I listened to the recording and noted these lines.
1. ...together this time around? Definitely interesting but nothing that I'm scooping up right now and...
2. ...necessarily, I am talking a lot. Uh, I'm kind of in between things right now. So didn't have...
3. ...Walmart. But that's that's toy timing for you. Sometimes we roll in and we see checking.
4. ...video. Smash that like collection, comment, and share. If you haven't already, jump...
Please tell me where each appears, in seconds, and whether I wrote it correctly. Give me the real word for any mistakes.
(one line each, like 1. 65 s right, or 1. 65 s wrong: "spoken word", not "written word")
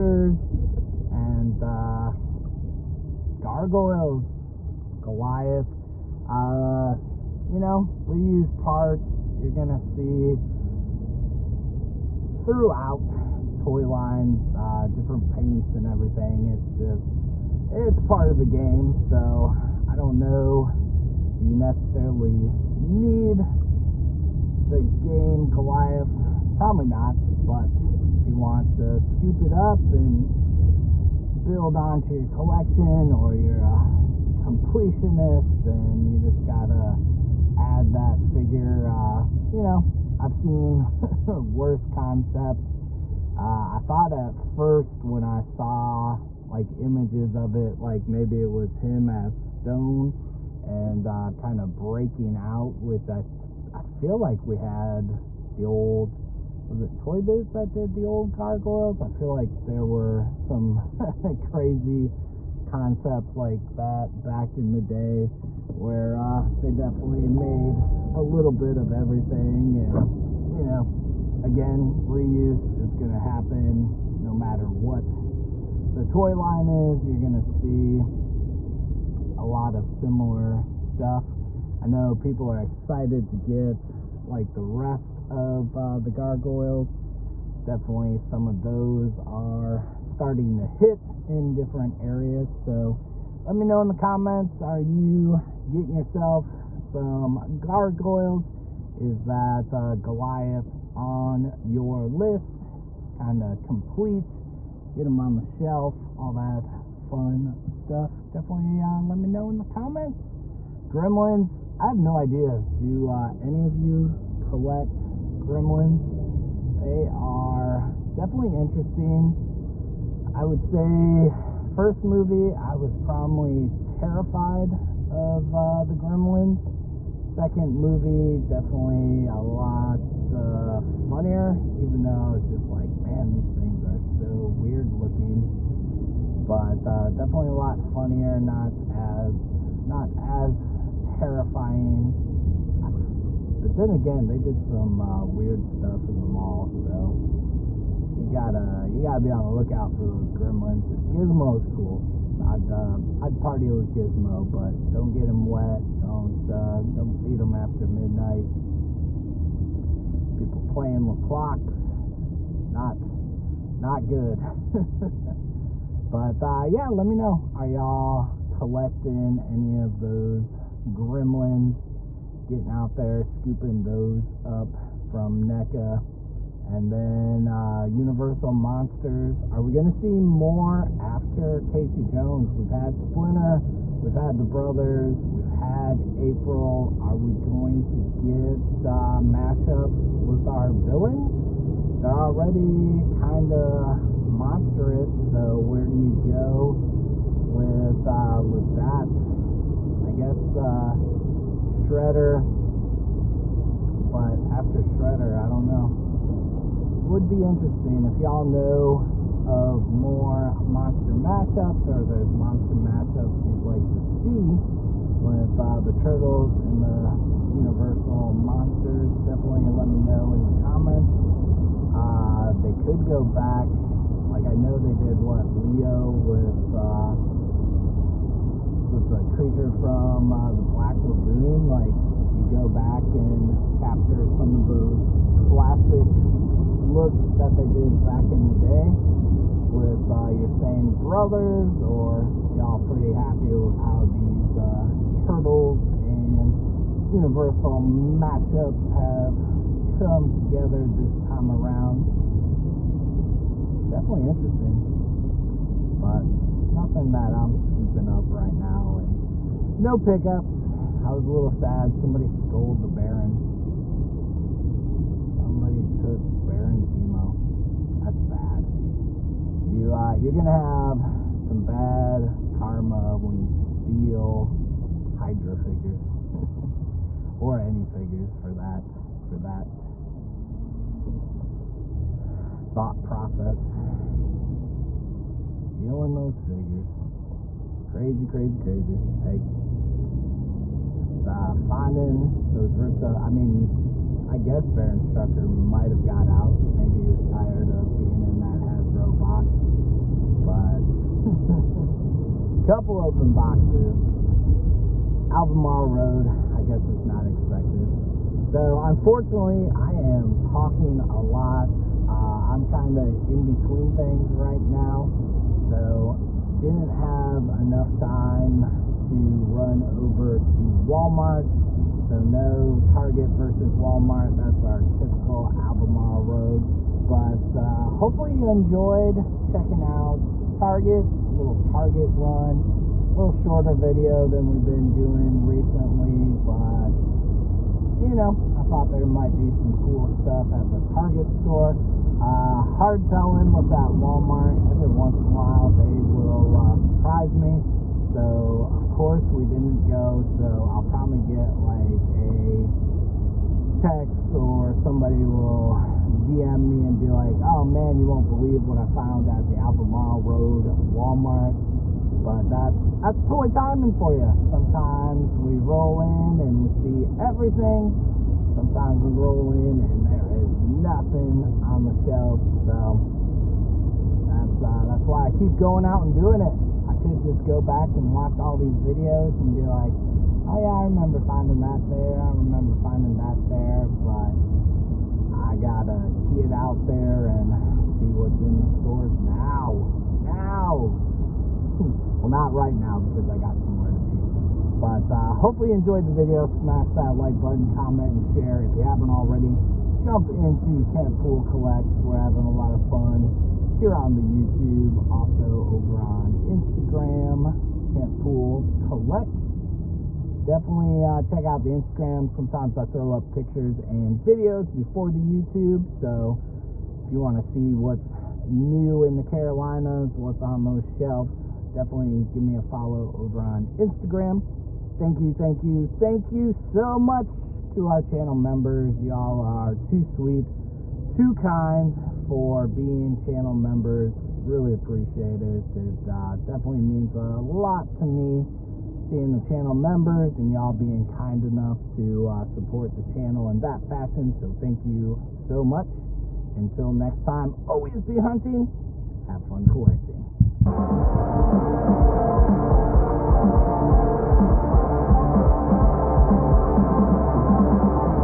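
1. 250 s right
2. 308 s wrong: "unfortunately", not "necessarily"
3. 360 s wrong: "everything", not "checking"
4. 396 s wrong: "button", not "collection".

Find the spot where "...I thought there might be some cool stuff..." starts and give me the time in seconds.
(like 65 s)
338 s.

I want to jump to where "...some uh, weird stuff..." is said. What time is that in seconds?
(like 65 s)
144 s.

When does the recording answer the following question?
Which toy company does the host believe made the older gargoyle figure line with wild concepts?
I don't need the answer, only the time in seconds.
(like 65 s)
56 s.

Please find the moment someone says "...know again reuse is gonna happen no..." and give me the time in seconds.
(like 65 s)
70 s.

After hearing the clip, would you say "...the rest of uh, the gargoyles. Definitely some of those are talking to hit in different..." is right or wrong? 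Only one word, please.
wrong.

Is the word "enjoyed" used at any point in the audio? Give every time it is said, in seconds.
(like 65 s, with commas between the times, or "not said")
328 s, 395 s.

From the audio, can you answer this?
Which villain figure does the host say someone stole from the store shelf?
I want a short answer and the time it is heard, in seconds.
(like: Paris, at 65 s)
Baron Zemo, at 266 s.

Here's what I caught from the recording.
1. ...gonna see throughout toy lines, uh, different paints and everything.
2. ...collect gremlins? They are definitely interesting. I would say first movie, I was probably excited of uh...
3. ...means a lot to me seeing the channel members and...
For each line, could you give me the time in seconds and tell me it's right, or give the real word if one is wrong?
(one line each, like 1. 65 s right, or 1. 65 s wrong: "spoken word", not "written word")
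1. 9 s right
2. 114 s wrong: "terrified", not "excited"
3. 436 s right.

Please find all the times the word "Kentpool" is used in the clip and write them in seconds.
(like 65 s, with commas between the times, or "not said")
400 s, 407 s.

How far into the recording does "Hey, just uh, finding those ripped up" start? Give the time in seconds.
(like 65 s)
289 s.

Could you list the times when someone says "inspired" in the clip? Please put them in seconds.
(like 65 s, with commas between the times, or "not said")
not said.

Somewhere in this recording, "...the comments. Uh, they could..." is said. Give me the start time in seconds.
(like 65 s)
220 s.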